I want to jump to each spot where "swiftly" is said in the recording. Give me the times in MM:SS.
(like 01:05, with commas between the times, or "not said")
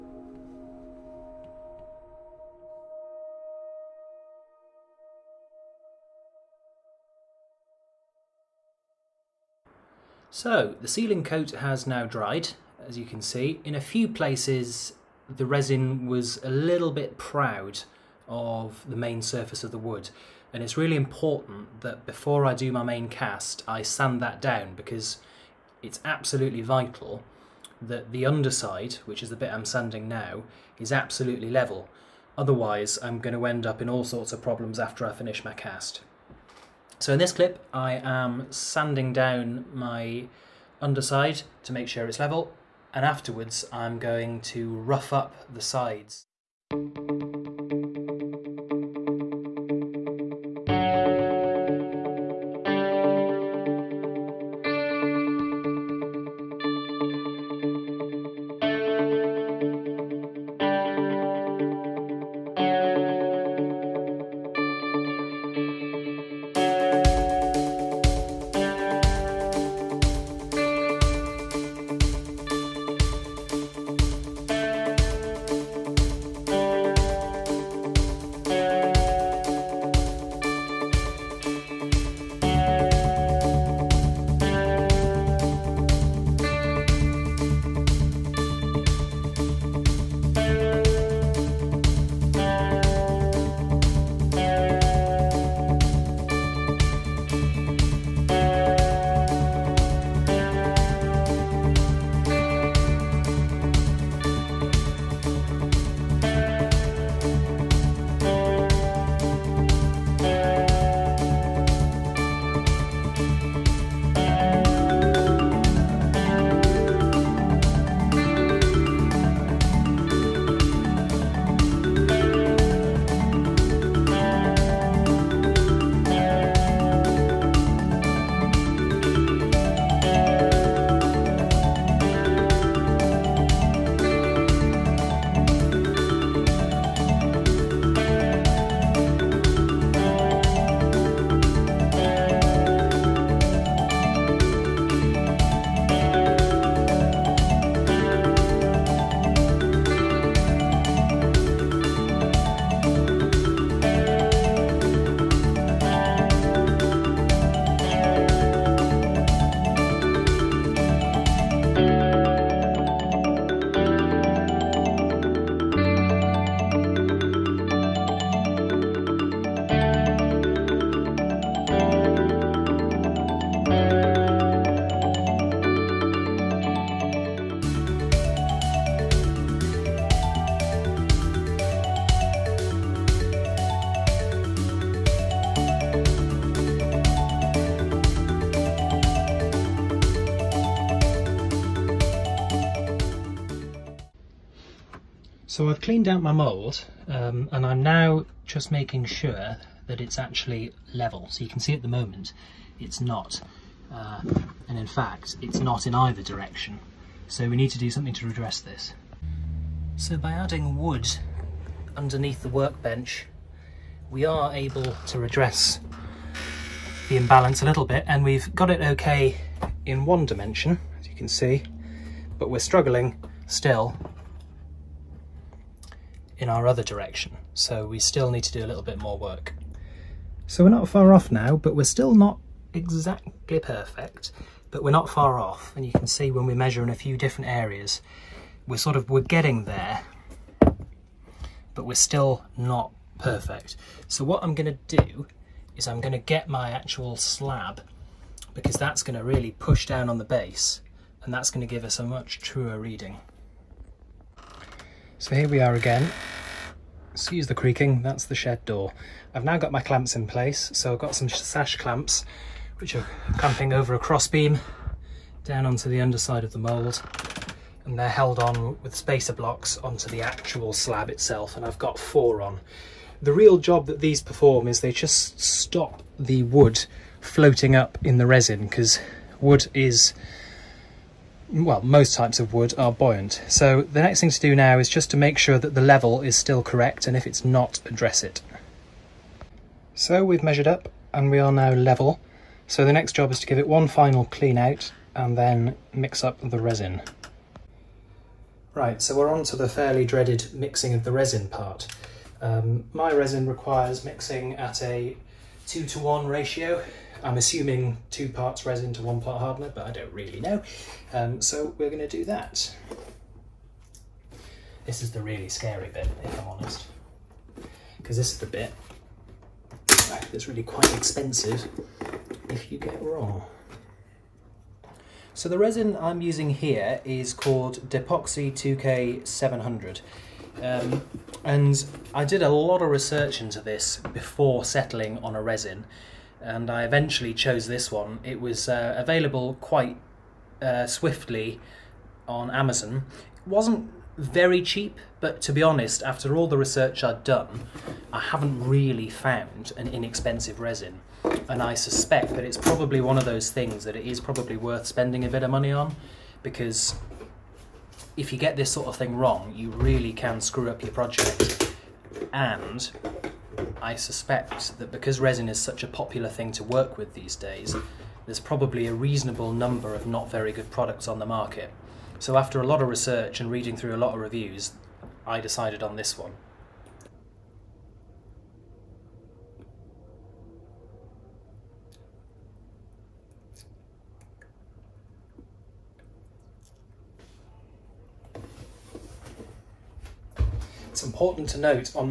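05:40.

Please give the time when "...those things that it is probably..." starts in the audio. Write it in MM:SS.
05:53.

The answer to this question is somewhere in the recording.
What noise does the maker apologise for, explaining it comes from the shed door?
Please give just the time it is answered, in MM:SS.
04:17.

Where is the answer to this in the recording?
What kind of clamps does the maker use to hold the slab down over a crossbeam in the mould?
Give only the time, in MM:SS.
04:21.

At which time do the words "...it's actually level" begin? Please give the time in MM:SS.
03:20.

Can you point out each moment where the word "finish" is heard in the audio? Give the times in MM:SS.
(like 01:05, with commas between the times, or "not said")
00:35.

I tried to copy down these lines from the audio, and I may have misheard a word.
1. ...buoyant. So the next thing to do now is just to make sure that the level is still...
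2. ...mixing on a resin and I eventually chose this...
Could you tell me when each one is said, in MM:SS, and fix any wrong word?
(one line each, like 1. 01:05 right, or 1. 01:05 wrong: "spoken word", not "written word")
1. 04:42 right
2. 05:34 wrong: "settling", not "mixing".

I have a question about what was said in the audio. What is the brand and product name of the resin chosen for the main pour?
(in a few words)
Depoxy 2K700.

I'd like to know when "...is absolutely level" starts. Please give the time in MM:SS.
00:30.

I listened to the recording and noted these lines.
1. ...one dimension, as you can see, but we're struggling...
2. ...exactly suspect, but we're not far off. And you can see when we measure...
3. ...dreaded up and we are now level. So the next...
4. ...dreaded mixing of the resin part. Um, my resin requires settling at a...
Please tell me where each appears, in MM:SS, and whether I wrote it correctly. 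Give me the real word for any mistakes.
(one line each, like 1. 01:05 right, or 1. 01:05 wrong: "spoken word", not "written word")
1. 03:40 right
2. 03:52 wrong: "perfect", not "suspect"
3. 04:50 wrong: "measured", not "dreaded"
4. 05:00 wrong: "mixing", not "settling".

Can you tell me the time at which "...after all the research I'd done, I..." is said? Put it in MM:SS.
05:46.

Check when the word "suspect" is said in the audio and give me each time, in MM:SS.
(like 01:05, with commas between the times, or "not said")
05:51, 06:03.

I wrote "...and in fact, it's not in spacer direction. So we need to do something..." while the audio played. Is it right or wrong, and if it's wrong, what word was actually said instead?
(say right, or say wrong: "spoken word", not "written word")
wrong: "either", not "spacer".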